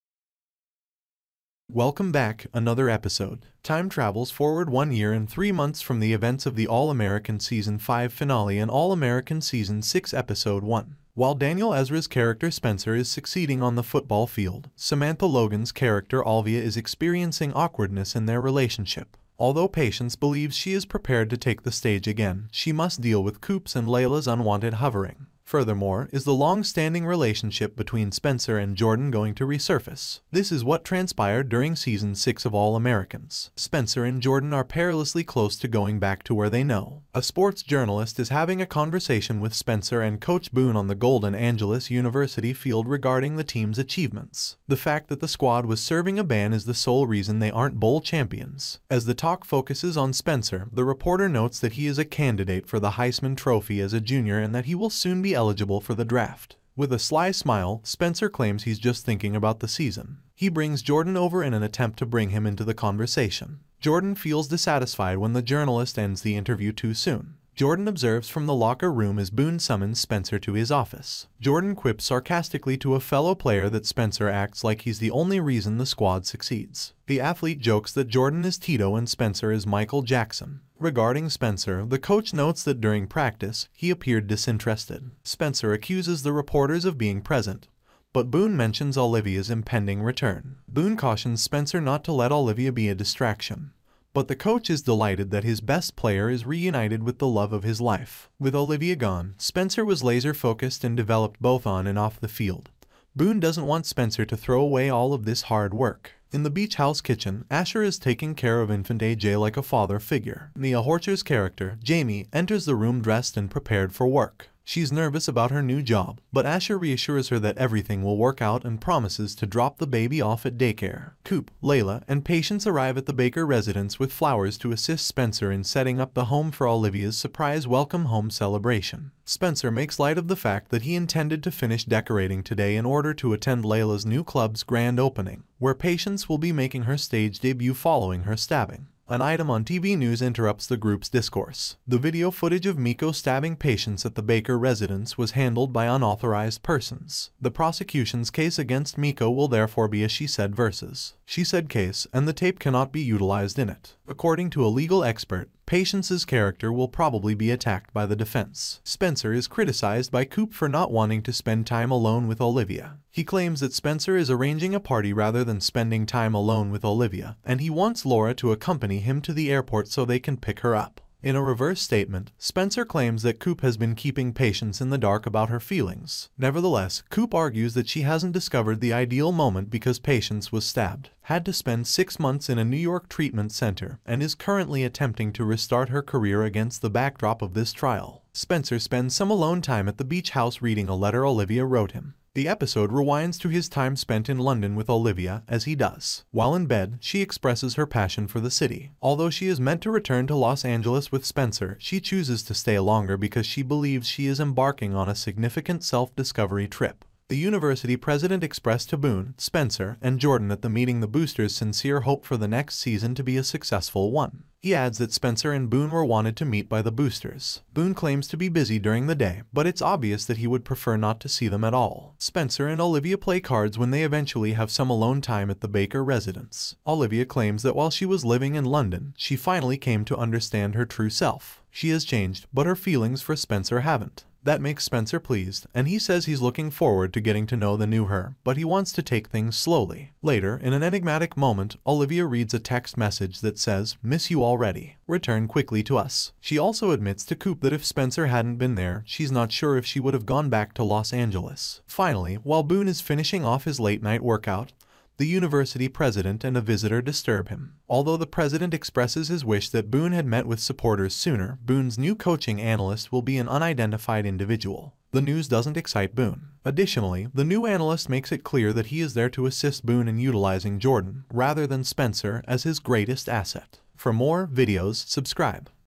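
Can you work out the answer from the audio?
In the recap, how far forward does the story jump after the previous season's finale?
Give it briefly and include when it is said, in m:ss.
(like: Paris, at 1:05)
1 year and 3 months, at 0:04.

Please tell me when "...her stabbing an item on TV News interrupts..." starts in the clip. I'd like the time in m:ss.
2:18.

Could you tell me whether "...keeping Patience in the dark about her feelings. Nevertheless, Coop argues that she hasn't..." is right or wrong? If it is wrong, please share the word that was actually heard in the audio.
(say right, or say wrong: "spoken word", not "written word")
right.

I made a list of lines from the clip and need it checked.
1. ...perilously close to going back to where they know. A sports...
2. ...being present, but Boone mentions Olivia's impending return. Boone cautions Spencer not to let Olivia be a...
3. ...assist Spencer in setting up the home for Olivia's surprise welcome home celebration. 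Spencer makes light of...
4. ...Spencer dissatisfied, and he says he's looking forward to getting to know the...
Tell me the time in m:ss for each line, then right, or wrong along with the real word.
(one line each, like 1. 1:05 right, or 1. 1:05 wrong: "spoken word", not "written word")
1. 0:34 right
2. 1:26 right
3. 2:04 right
4. 3:54 wrong: "pleased", not "dissatisfied".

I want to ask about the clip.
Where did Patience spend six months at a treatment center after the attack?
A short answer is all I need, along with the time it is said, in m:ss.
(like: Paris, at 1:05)
New York, at 3:02.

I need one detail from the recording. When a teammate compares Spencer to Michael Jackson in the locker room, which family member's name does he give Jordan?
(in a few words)
Tito.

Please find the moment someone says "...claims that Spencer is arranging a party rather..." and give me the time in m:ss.
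2:43.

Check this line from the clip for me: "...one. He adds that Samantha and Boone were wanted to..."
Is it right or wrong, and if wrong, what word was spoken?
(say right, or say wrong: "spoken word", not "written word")
wrong: "Spencer", not "Samantha".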